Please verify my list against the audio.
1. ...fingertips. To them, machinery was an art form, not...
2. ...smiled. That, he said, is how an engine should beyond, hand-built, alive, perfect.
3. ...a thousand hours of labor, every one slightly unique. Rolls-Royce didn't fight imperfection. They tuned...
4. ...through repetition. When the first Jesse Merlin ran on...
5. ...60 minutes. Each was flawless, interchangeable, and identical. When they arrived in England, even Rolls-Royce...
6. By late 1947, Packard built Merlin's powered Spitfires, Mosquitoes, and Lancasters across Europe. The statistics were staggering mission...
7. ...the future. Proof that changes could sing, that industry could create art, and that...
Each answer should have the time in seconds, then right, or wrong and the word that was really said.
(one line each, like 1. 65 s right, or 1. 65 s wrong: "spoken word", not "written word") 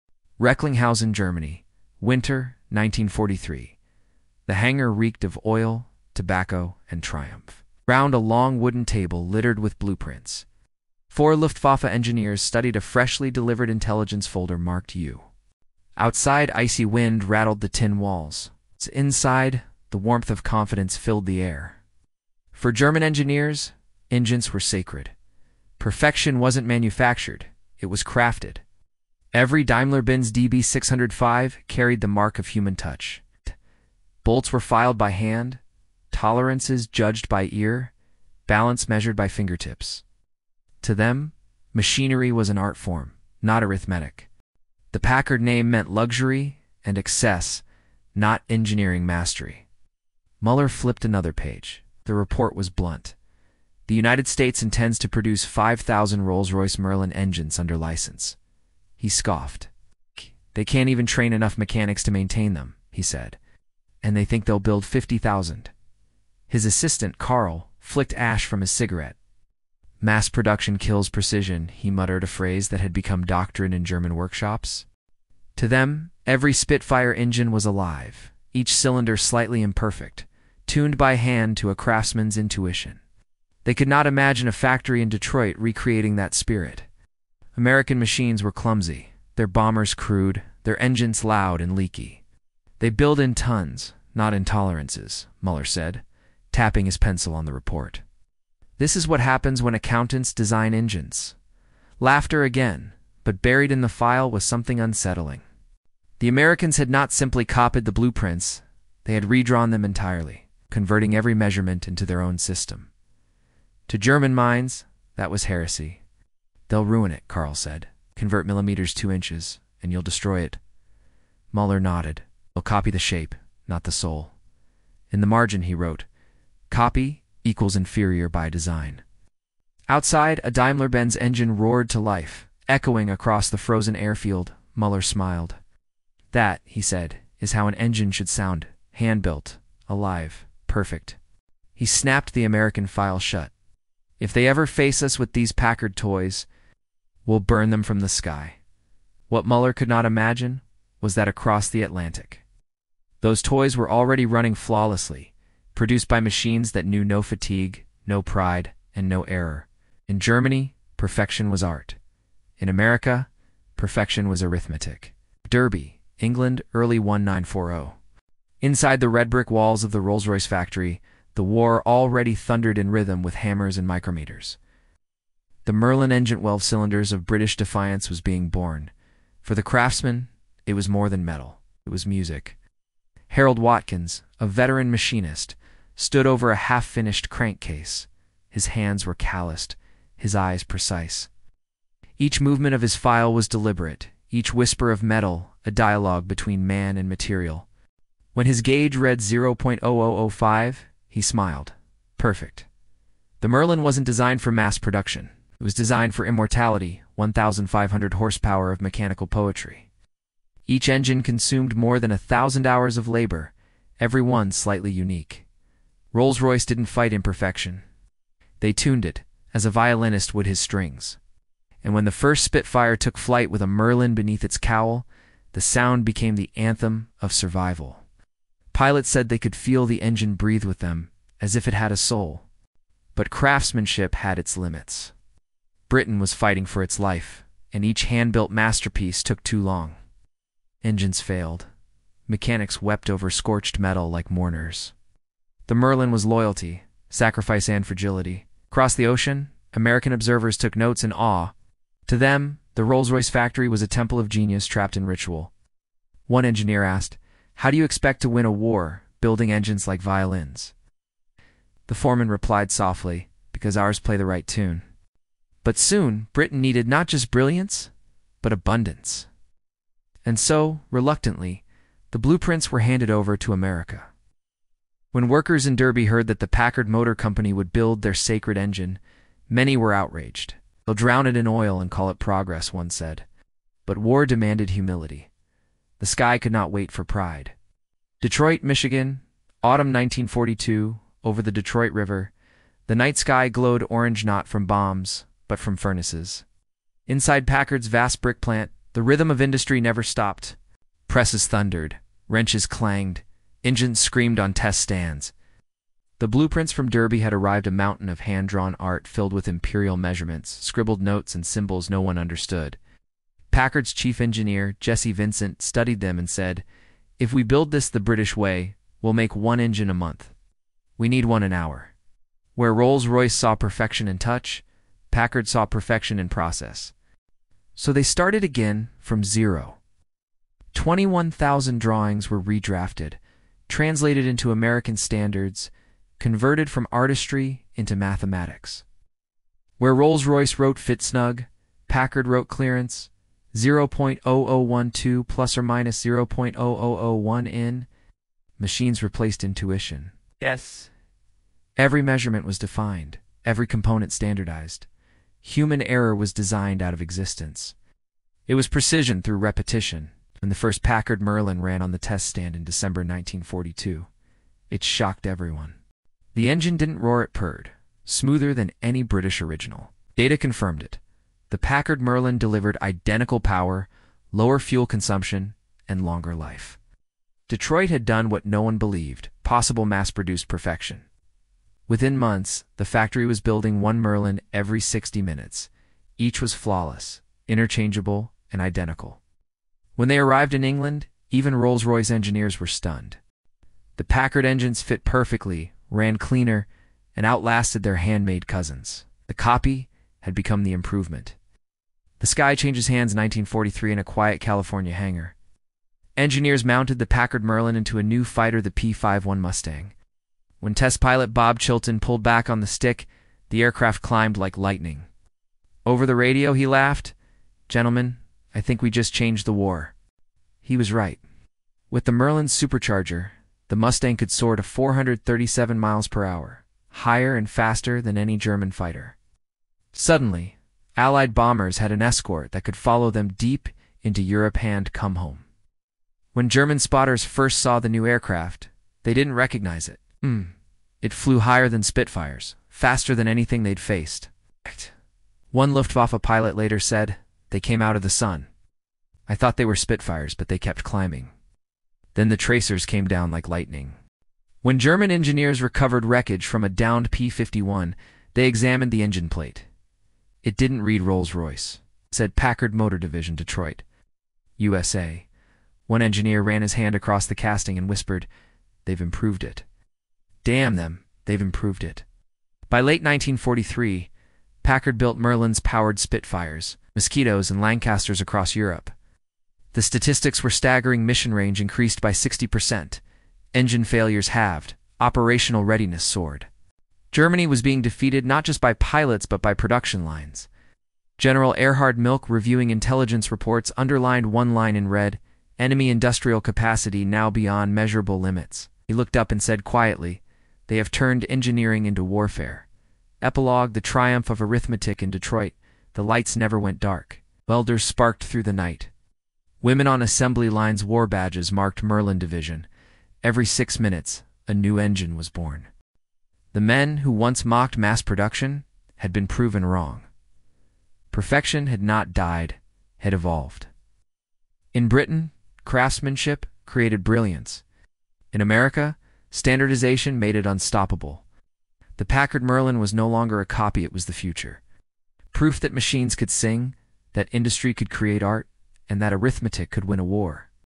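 1. 39 s right
2. 135 s wrong: "sound", not "beyond"
3. 212 s right
4. 359 s wrong: "Packard", not "Jesse"
5. 384 s right
6. 472 s wrong: "1943", not "1947"
7. 534 s wrong: "machines", not "changes".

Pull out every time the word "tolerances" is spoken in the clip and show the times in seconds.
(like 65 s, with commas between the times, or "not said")
36 s, 94 s.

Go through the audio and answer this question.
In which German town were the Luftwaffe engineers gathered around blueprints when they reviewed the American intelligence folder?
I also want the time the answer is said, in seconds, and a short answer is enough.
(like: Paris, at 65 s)
Recklinghausen, at 0 s.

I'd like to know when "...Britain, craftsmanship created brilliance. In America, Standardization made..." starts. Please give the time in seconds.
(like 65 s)
524 s.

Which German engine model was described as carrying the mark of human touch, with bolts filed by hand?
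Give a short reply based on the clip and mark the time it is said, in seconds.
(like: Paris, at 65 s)
DB605, at 30 s.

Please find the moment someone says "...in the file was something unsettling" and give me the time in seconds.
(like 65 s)
103 s.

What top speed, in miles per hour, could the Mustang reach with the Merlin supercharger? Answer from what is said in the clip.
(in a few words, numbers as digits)
437.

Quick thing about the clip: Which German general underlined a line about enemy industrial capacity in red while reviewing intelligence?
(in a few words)
Erhard Milch.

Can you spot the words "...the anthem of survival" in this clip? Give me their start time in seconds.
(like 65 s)
226 s.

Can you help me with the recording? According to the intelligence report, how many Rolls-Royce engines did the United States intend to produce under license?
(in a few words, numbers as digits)
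5,000.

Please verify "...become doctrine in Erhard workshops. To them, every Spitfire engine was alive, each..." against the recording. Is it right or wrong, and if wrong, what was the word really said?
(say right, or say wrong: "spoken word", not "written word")
wrong: "German", not "Erhard".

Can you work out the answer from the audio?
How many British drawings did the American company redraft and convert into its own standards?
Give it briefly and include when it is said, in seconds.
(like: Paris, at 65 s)
21,000, at 330 s.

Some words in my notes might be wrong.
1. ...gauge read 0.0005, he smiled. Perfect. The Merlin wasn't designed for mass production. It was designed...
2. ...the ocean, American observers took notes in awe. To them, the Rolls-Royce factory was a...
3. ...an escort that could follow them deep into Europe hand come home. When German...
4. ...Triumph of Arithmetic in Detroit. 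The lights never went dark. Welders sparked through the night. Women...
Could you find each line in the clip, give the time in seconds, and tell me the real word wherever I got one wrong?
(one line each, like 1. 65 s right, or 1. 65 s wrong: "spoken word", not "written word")
1. 198 s right
2. 248 s right
3. 431 s right
4. 503 s right.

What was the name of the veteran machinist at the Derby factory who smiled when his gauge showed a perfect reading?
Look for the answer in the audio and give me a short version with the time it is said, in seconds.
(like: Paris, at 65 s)
Harold Watkins, at 183 s.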